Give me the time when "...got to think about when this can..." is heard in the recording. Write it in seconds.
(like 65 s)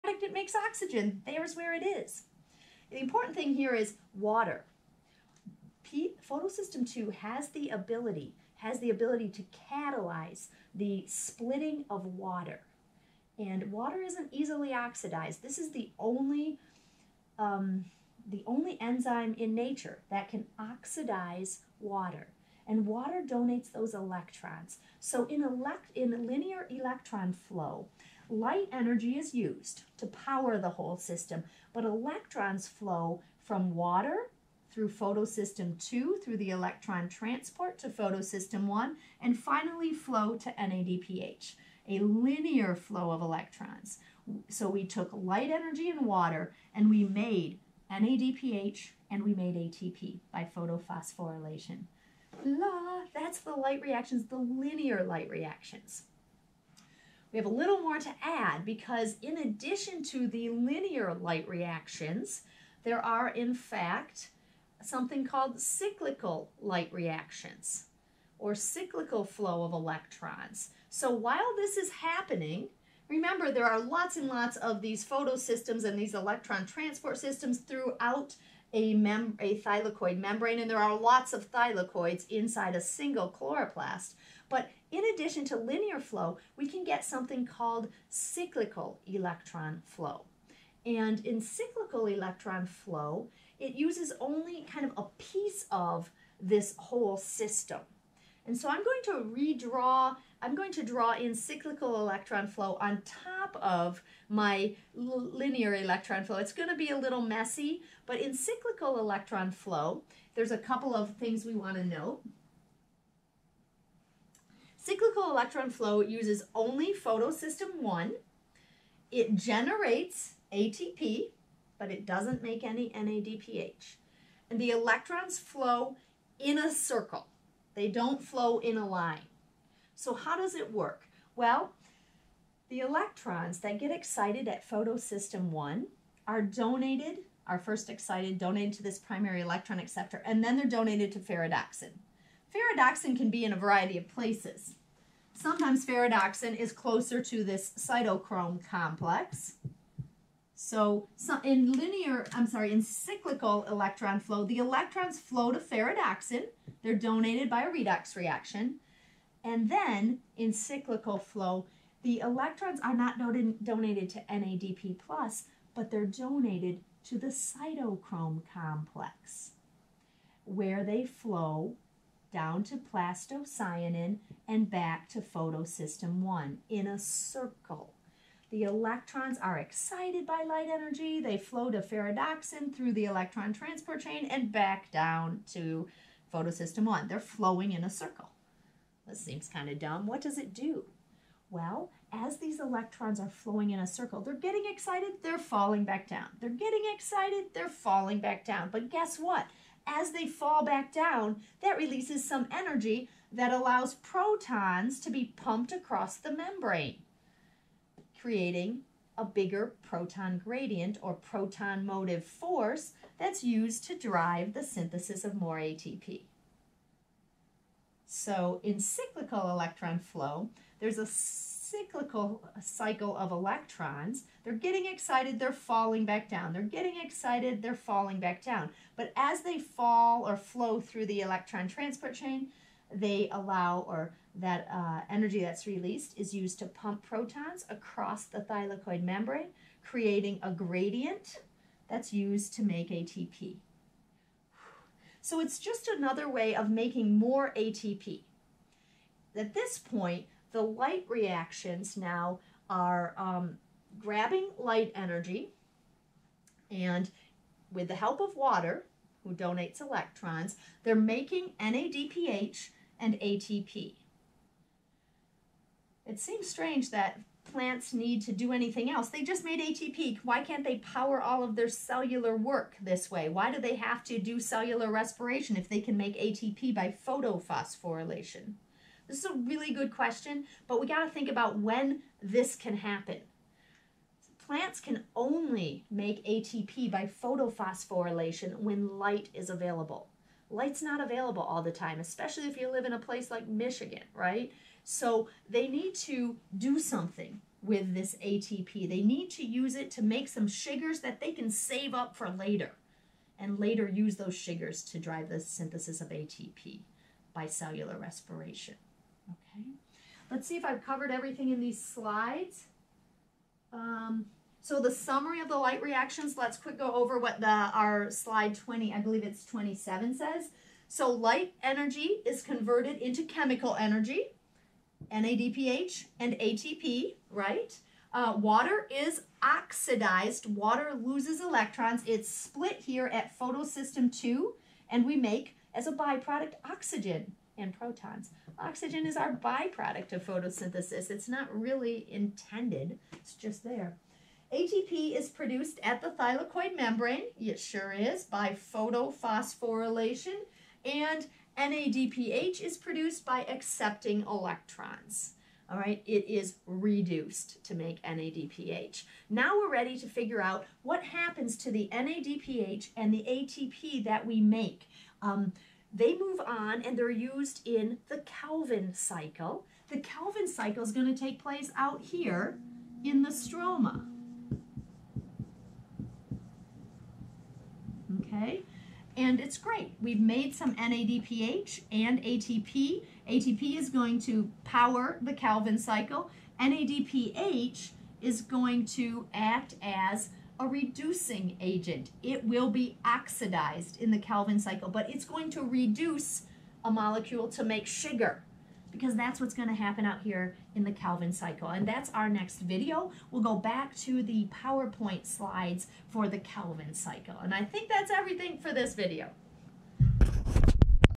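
280 s.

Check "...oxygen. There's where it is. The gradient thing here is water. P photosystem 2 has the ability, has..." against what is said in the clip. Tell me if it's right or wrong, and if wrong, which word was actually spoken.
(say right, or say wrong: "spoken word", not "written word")
wrong: "important", not "gradient".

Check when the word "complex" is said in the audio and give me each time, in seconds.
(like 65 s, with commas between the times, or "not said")
148 s, 168 s.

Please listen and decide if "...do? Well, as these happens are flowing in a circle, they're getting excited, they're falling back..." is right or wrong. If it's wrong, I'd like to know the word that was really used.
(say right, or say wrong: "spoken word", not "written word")
wrong: "electrons", not "happens".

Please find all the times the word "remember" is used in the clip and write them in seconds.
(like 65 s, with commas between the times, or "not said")
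73 s.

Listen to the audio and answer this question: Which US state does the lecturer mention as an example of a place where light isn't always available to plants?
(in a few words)
Michigan.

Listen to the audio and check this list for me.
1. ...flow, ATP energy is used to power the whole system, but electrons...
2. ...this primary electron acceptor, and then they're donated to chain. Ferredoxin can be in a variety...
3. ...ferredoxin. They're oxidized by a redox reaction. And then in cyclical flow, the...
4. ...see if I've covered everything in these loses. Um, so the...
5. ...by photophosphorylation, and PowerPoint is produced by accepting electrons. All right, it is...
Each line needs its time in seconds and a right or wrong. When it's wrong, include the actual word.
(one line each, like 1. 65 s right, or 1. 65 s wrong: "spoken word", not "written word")
1. 27 s wrong: "Light", not "ATP"
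2. 138 s wrong: "ferredoxin", not "chain"
3. 155 s wrong: "donated", not "oxidized"
4. 310 s wrong: "slides", not "loses"
5. 348 s wrong: "NADPH", not "PowerPoint".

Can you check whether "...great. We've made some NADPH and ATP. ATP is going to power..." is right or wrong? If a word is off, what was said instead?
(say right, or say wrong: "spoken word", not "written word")
right.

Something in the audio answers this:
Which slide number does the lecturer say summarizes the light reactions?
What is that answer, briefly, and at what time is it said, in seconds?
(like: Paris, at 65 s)
27, at 319 s.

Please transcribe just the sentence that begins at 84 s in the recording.
But in addition to linear flow, we can get something called cyclical electron flow.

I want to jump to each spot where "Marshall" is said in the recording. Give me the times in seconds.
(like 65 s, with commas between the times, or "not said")
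not said.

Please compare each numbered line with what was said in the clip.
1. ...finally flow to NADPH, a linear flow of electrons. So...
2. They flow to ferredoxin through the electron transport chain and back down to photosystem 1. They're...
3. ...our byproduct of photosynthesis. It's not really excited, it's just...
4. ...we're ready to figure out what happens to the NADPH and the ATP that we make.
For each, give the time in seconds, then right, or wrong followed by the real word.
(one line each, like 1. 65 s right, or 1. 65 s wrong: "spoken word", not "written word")
1. 39 s right
2. 181 s right
3. 339 s wrong: "intended", not "excited"
4. 359 s right.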